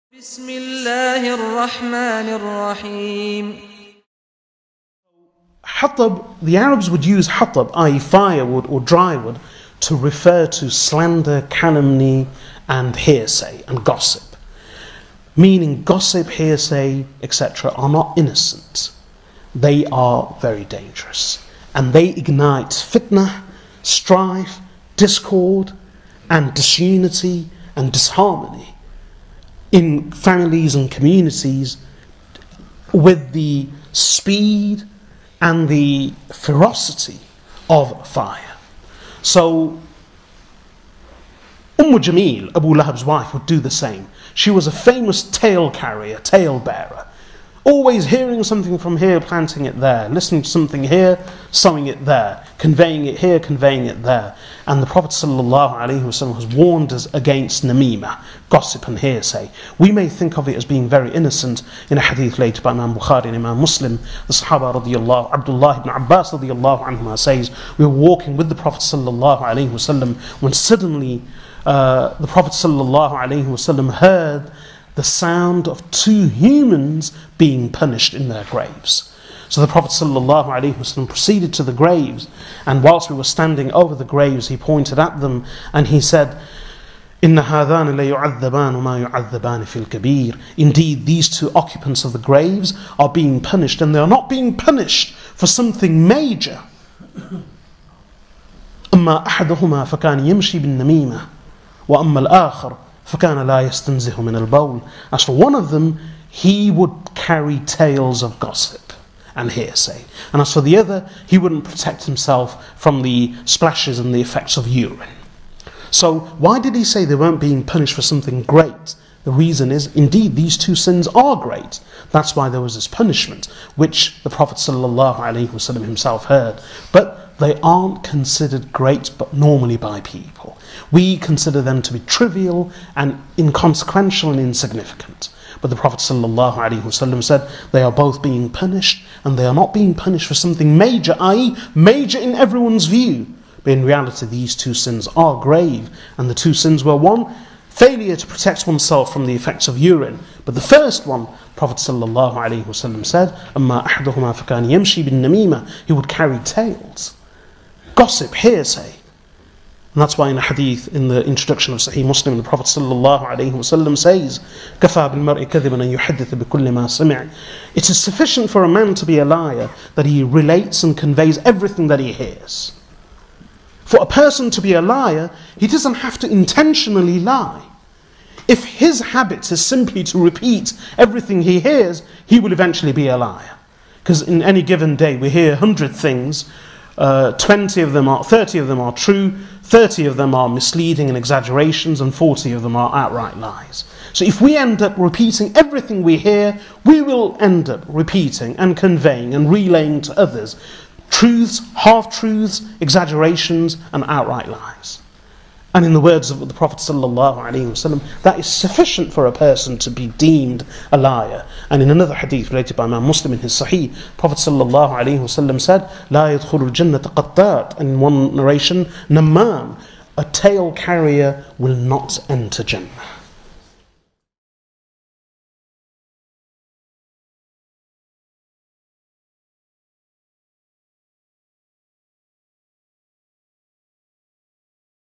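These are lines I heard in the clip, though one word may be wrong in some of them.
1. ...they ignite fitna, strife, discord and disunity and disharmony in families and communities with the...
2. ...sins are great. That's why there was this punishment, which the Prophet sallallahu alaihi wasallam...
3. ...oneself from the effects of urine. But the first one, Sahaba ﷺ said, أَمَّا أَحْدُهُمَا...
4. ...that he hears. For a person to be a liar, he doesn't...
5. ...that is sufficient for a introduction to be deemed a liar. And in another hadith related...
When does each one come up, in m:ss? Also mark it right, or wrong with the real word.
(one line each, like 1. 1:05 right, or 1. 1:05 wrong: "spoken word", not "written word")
1. 0:21 right
2. 2:00 right
3. 2:28 wrong: "Prophet", not "Sahaba"
4. 2:51 right
5. 3:28 wrong: "person", not "introduction".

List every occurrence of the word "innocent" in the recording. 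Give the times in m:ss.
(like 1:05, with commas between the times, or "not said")
0:18, 1:01.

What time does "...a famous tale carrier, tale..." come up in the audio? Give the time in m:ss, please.
0:44.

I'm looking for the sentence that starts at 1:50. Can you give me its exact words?
And as for the other, he wouldn't protect himself from the splashes and the effects of urine.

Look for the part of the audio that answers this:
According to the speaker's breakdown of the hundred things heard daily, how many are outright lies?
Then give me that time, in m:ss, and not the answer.
3:12.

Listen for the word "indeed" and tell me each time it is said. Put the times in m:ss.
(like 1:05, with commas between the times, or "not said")
1:27, 1:59.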